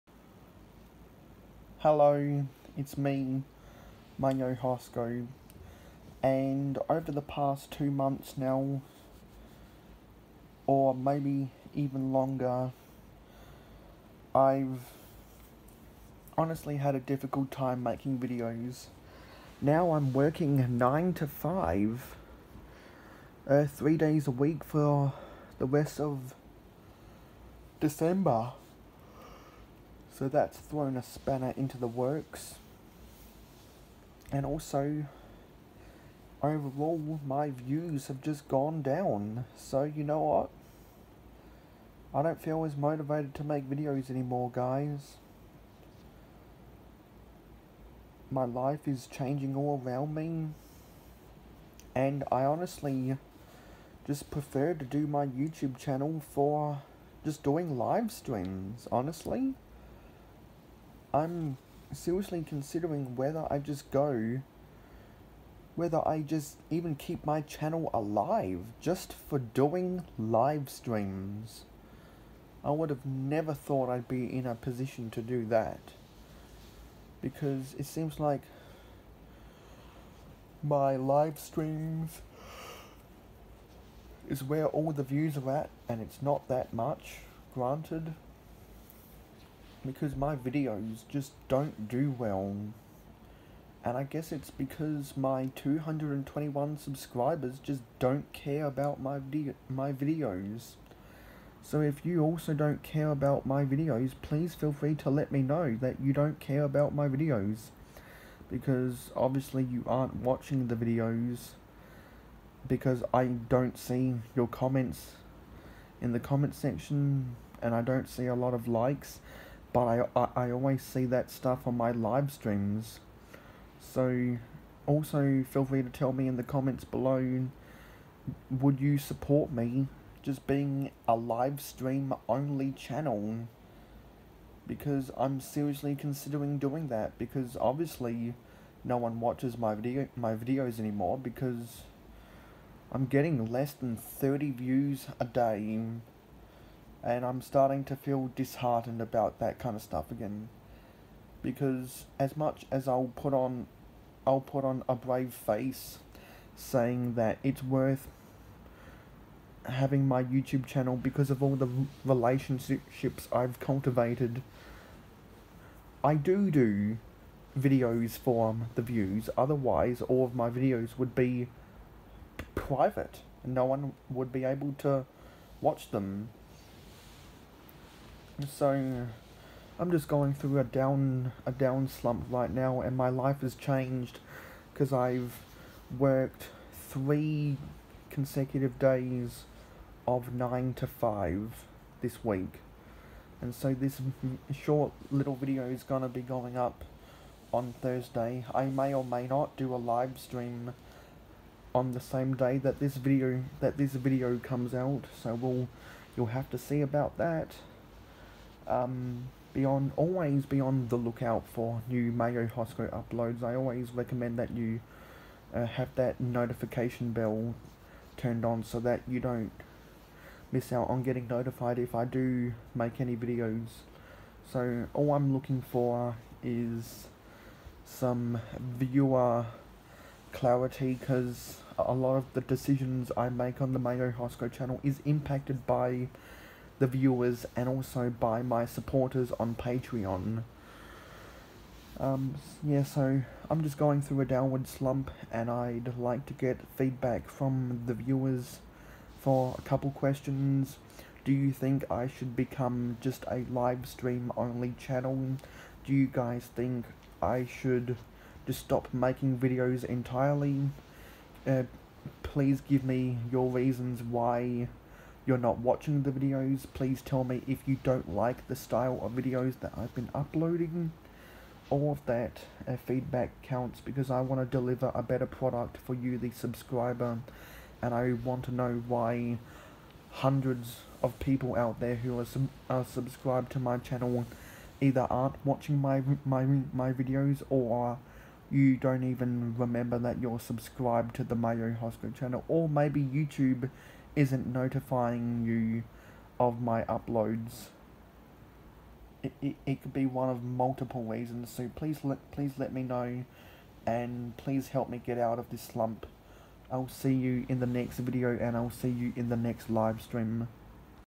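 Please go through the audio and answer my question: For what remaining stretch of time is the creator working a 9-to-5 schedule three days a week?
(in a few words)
the rest of December.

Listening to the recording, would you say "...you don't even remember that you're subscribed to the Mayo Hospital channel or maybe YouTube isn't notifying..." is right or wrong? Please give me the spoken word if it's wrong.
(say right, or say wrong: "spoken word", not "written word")
right.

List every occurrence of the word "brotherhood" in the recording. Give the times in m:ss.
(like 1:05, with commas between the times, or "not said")
not said.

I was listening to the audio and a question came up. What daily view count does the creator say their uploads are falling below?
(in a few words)
30 views.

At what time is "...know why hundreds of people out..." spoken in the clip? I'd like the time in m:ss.
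4:38.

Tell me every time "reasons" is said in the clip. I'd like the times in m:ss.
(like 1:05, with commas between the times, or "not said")
4:23, 5:01.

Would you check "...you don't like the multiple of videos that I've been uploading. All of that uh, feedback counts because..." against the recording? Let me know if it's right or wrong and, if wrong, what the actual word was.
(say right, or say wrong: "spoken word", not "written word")
wrong: "style", not "multiple".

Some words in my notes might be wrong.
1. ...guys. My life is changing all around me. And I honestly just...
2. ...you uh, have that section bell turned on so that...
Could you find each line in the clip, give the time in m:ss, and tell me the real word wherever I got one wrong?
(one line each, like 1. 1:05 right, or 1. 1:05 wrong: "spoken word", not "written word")
1. 0:44 right
2. 3:34 wrong: "notification", not "section".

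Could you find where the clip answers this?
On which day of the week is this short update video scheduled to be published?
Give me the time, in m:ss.
3:17.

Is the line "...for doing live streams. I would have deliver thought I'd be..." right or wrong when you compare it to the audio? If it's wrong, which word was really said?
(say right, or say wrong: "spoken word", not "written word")
wrong: "never", not "deliver".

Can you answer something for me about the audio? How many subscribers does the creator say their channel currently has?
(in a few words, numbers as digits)
221.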